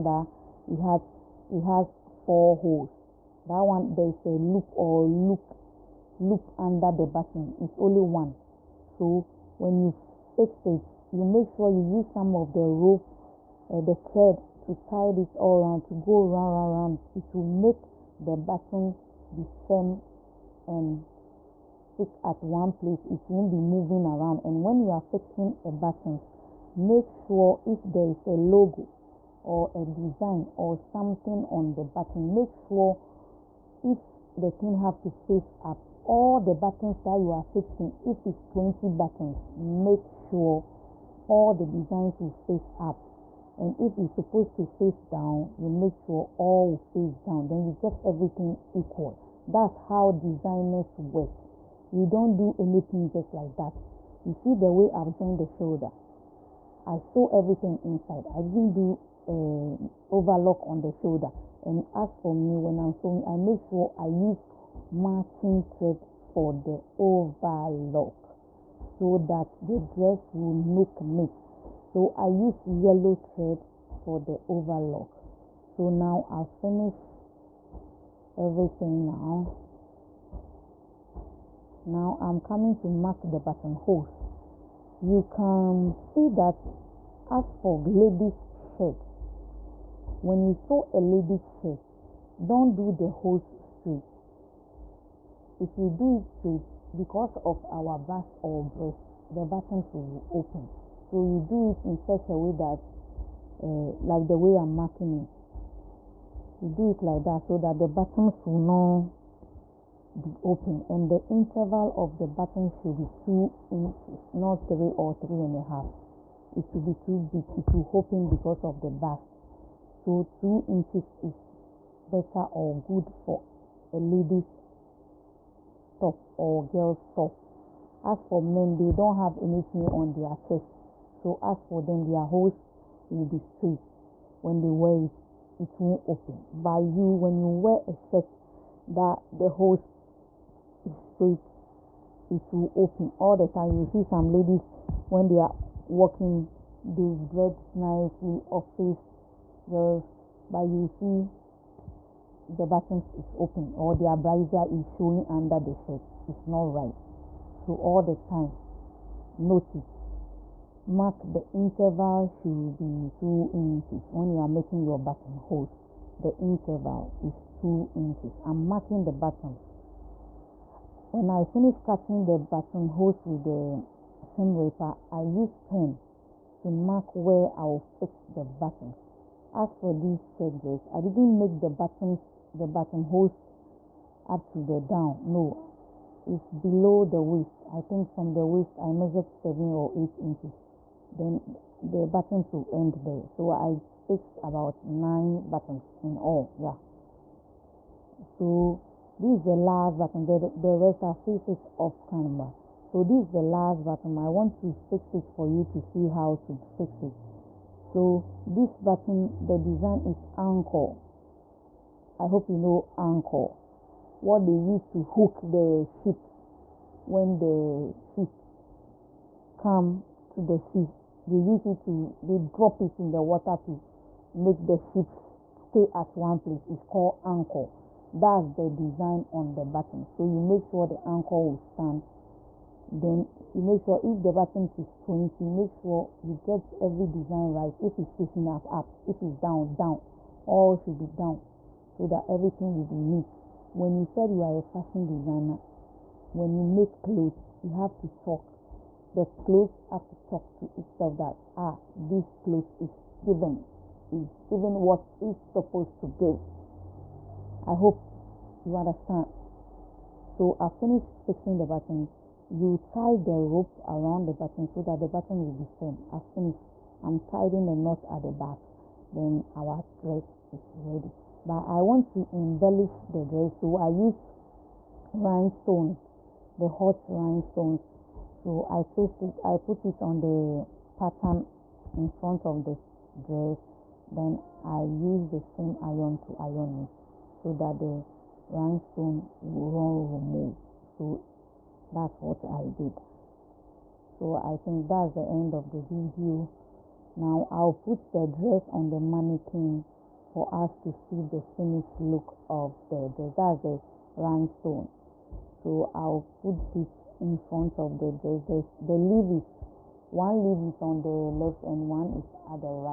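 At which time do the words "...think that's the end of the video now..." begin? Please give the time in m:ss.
4:54.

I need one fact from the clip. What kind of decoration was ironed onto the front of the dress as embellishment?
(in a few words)
Hot rhinestones.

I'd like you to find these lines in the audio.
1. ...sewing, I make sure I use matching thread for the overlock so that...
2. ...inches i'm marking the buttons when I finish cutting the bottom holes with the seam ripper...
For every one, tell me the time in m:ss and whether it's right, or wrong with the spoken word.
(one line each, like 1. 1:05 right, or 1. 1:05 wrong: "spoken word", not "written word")
1. 1:02 right
2. 2:47 right.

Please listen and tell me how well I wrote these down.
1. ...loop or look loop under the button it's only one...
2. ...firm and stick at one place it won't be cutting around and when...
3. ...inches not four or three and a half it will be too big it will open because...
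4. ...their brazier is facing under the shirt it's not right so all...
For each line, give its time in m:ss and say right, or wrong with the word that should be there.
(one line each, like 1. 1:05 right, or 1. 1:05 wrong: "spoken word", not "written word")
1. 0:04 right
2. 0:19 wrong: "moving", not "cutting"
3. 1:53 wrong: "three", not "four"
4. 2:33 wrong: "showing", not "facing".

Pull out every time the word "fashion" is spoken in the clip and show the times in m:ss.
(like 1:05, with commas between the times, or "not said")
4:04.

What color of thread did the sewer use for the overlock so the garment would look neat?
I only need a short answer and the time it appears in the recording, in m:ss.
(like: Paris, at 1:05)
Yellow, at 1:12.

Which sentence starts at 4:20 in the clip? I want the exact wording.
So I finish fixing the button.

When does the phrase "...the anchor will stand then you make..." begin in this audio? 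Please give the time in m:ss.
3:50.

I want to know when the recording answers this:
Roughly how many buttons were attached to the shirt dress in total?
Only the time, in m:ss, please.
3:14.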